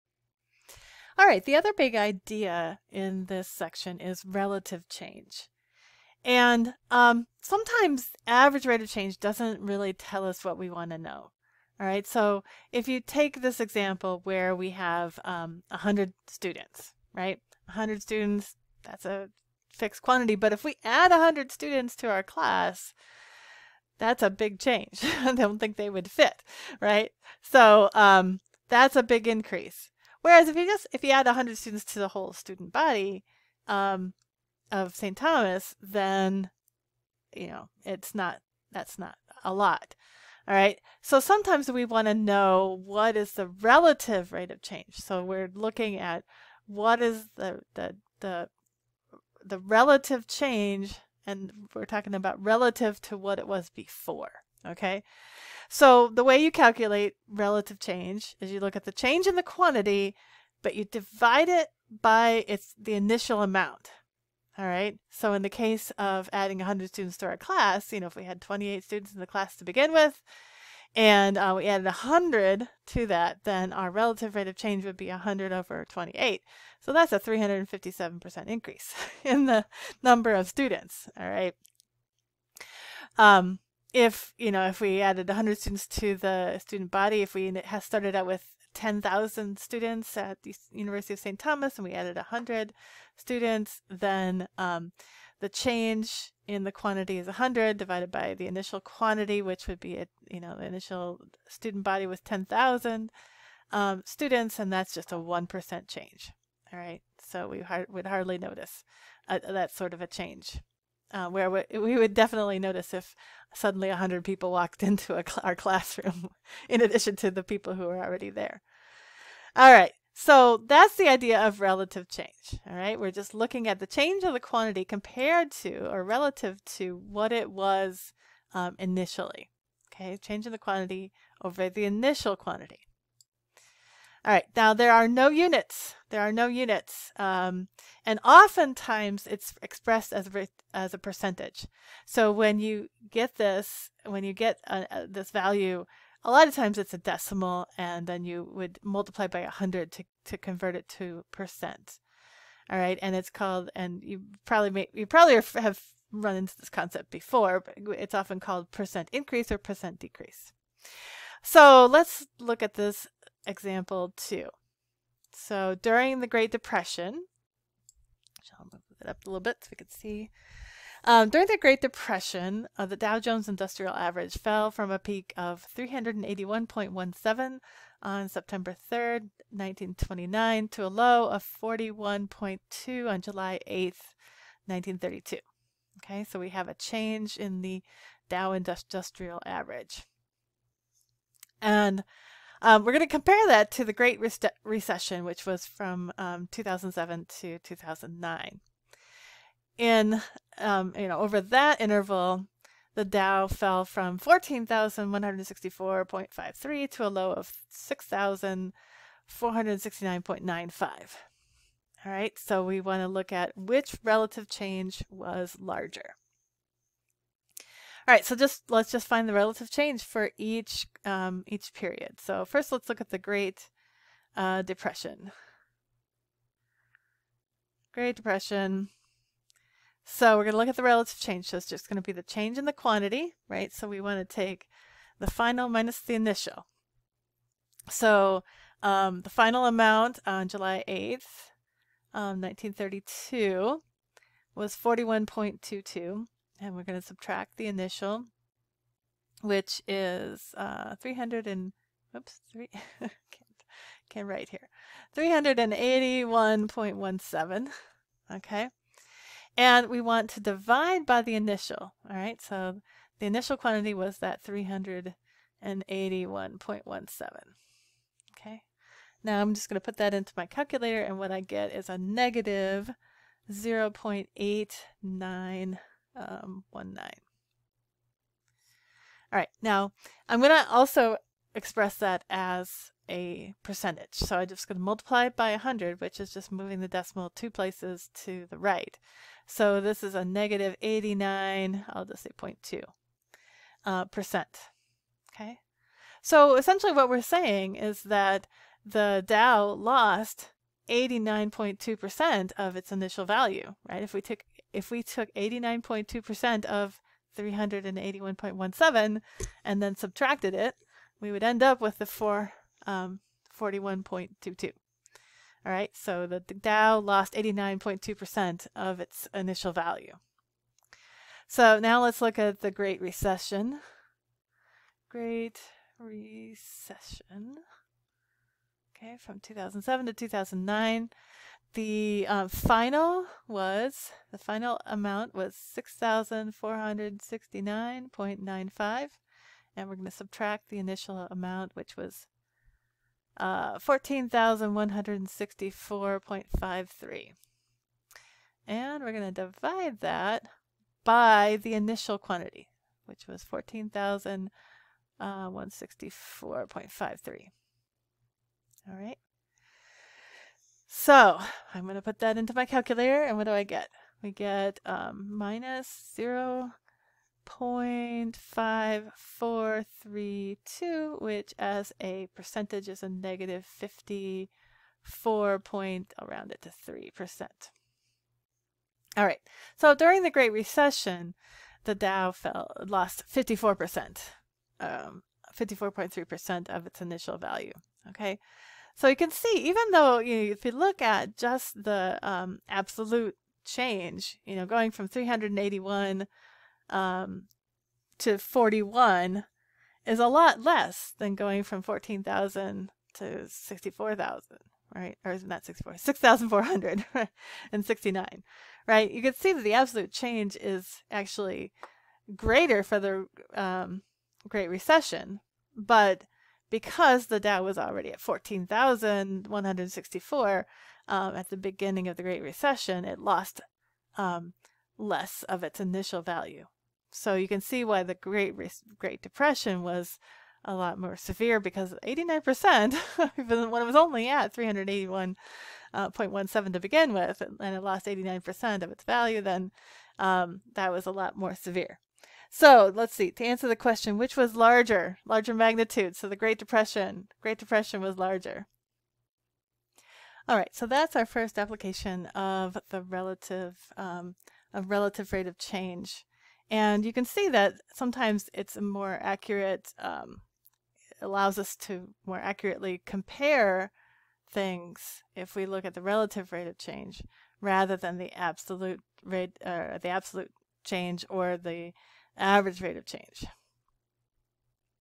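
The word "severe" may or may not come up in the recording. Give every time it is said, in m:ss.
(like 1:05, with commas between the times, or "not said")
7:11, 7:21.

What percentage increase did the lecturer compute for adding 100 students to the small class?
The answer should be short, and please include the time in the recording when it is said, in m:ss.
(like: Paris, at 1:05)
357%, at 1:17.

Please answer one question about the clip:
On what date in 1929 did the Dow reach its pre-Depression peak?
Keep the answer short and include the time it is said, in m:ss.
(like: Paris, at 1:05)
September 3rd, at 2:58.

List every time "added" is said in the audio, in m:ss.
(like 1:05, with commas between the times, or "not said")
1:11, 1:25, 1:31.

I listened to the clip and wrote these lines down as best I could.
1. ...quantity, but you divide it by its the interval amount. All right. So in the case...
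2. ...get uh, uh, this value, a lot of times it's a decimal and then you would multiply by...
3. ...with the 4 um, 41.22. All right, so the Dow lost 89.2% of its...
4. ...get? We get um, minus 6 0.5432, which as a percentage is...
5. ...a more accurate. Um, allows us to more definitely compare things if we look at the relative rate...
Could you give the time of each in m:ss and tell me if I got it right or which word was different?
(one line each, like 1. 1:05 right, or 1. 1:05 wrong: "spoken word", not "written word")
1. 0:59 wrong: "initial", not "interval"
2. 2:24 right
3. 5:11 right
4. 6:03 wrong: "0", not "6"
5. 7:38 wrong: "accurately", not "definitely".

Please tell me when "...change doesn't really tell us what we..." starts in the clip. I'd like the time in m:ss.
0:08.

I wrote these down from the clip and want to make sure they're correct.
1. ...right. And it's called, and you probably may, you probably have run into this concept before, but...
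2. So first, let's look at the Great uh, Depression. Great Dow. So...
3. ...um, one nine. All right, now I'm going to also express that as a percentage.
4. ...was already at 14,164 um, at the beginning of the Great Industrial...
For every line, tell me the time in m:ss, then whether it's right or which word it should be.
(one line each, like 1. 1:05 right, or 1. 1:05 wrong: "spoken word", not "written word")
1. 2:32 right
2. 3:42 wrong: "Depression", not "Dow"
3. 4:36 right
4. 6:57 wrong: "Recession", not "Industrial".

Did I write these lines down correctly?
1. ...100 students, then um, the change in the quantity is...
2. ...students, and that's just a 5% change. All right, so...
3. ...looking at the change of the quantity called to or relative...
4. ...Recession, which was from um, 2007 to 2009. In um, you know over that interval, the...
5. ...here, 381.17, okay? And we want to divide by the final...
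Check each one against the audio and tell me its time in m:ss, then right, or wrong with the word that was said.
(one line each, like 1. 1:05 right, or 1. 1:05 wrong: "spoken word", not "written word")
1. 1:32 right
2. 1:44 wrong: "1", not "5"
3. 2:03 wrong: "compared", not "called"
4. 3:14 right
5. 4:14 wrong: "initial", not "final".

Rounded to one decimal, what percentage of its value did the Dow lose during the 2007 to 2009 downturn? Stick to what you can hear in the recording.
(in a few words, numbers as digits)
54.3%.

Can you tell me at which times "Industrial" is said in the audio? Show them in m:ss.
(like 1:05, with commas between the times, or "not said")
2:53, 3:08.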